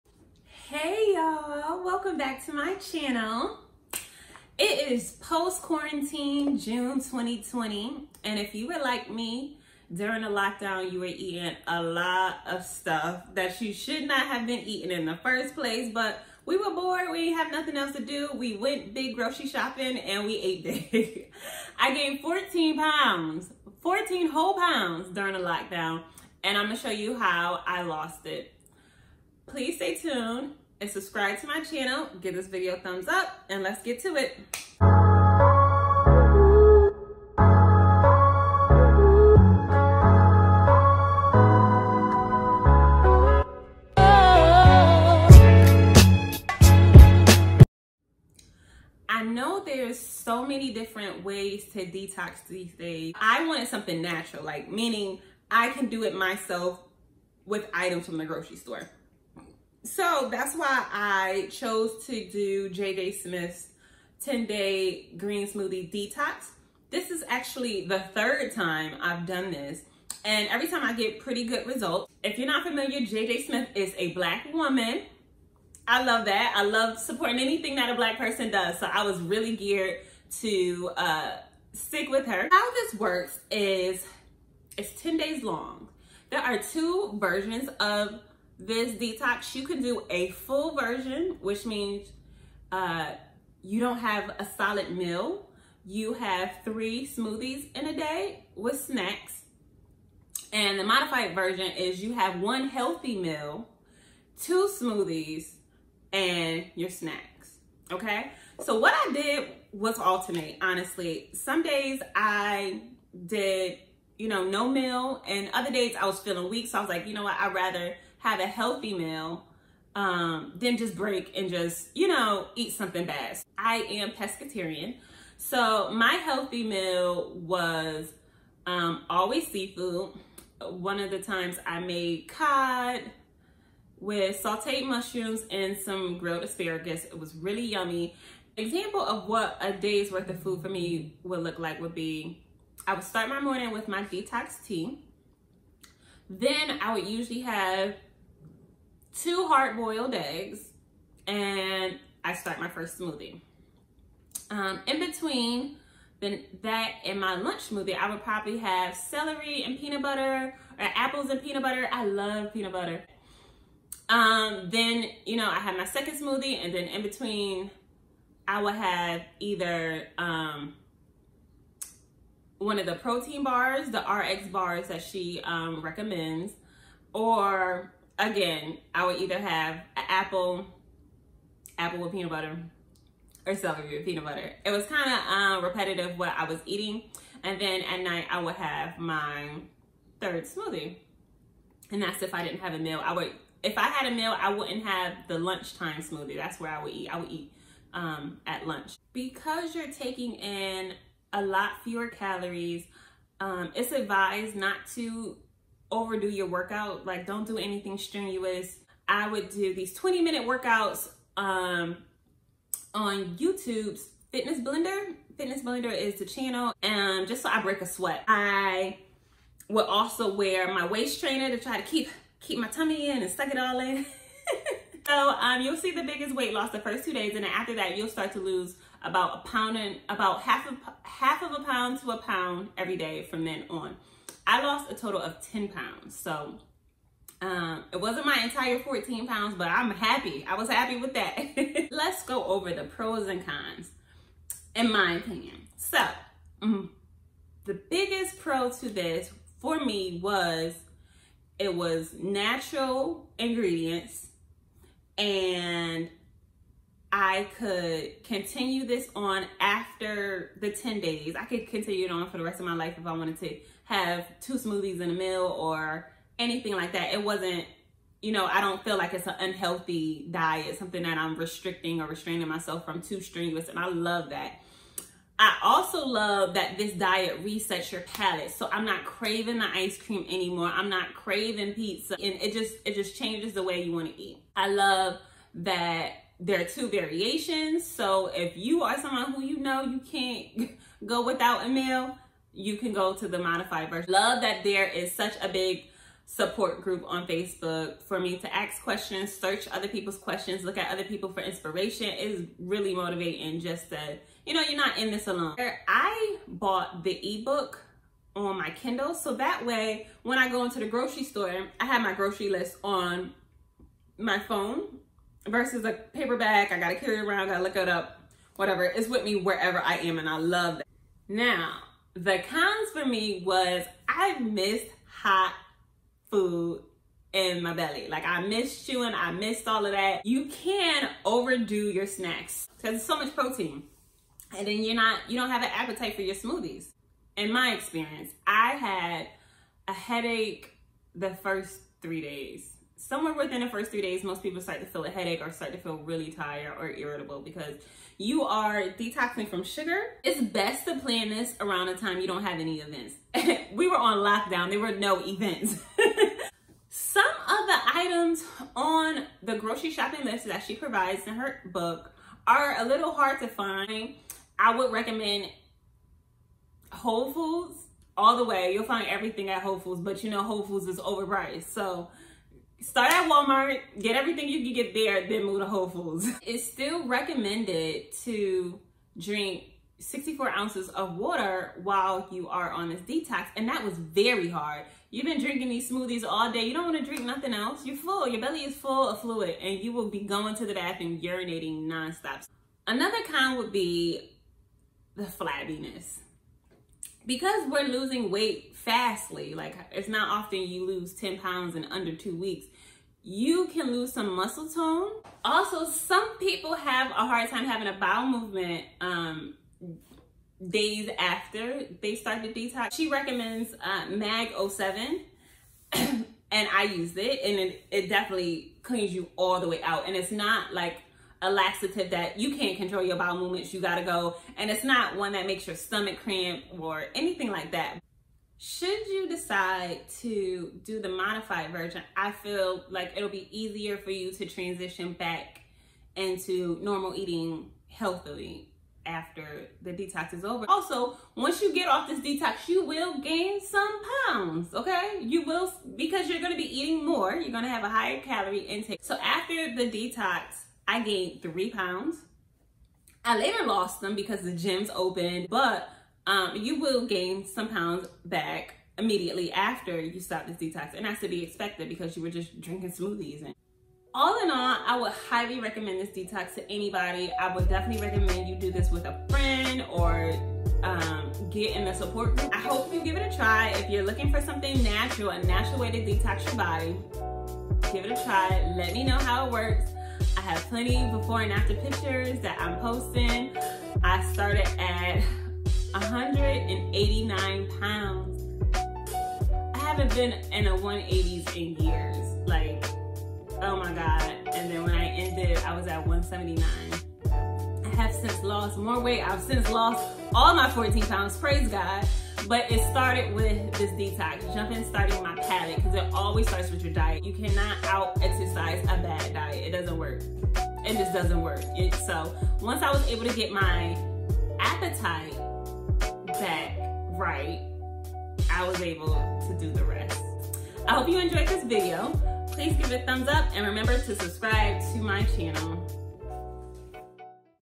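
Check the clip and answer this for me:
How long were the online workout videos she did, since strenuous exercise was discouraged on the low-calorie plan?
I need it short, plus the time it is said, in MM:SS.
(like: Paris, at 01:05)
20 minutes, at 03:29.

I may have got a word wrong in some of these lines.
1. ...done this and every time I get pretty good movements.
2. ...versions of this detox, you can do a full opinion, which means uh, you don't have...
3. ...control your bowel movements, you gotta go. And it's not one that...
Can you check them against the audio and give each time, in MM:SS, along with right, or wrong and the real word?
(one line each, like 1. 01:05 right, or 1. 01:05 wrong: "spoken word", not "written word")
1. 01:09 wrong: "results", not "movements"
2. 01:27 wrong: "version", not "opinion"
3. 07:02 right.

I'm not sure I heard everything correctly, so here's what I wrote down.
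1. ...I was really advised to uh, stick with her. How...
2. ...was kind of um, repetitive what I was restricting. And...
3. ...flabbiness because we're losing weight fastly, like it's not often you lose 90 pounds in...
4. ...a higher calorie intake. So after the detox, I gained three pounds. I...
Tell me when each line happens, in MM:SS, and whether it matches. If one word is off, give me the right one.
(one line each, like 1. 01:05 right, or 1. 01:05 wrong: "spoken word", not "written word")
1. 01:18 wrong: "geared", not "advised"
2. 03:04 wrong: "eating", not "restricting"
3. 06:35 wrong: "10", not "90"
4. 07:27 right.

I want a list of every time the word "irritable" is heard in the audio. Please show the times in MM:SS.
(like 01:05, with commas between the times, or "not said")
05:46.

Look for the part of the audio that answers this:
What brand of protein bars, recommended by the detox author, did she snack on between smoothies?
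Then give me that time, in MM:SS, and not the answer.
02:54.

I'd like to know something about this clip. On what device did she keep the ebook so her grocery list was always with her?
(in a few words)
Kindle.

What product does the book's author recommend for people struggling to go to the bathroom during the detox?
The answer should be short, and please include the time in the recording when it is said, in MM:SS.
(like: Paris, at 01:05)
MAG 07, at 06:54.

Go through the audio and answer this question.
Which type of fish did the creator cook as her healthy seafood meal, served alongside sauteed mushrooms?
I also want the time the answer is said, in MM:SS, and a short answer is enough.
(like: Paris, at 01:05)
Cod, at 02:12.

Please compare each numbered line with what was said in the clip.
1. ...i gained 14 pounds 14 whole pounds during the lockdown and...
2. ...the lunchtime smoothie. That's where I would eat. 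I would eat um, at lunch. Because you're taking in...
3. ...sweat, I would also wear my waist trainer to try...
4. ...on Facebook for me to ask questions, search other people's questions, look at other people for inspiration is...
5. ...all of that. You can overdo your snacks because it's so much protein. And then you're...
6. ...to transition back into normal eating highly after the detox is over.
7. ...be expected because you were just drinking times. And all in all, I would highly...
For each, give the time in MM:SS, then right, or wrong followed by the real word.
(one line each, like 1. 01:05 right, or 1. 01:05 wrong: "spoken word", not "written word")
1. 00:21 right
2. 03:15 right
3. 03:37 right
4. 04:57 right
5. 05:29 right
6. 07:14 wrong: "healthily", not "highly"
7. 07:41 wrong: "smoothies", not "times".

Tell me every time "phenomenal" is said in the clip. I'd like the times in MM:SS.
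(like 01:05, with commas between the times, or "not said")
not said.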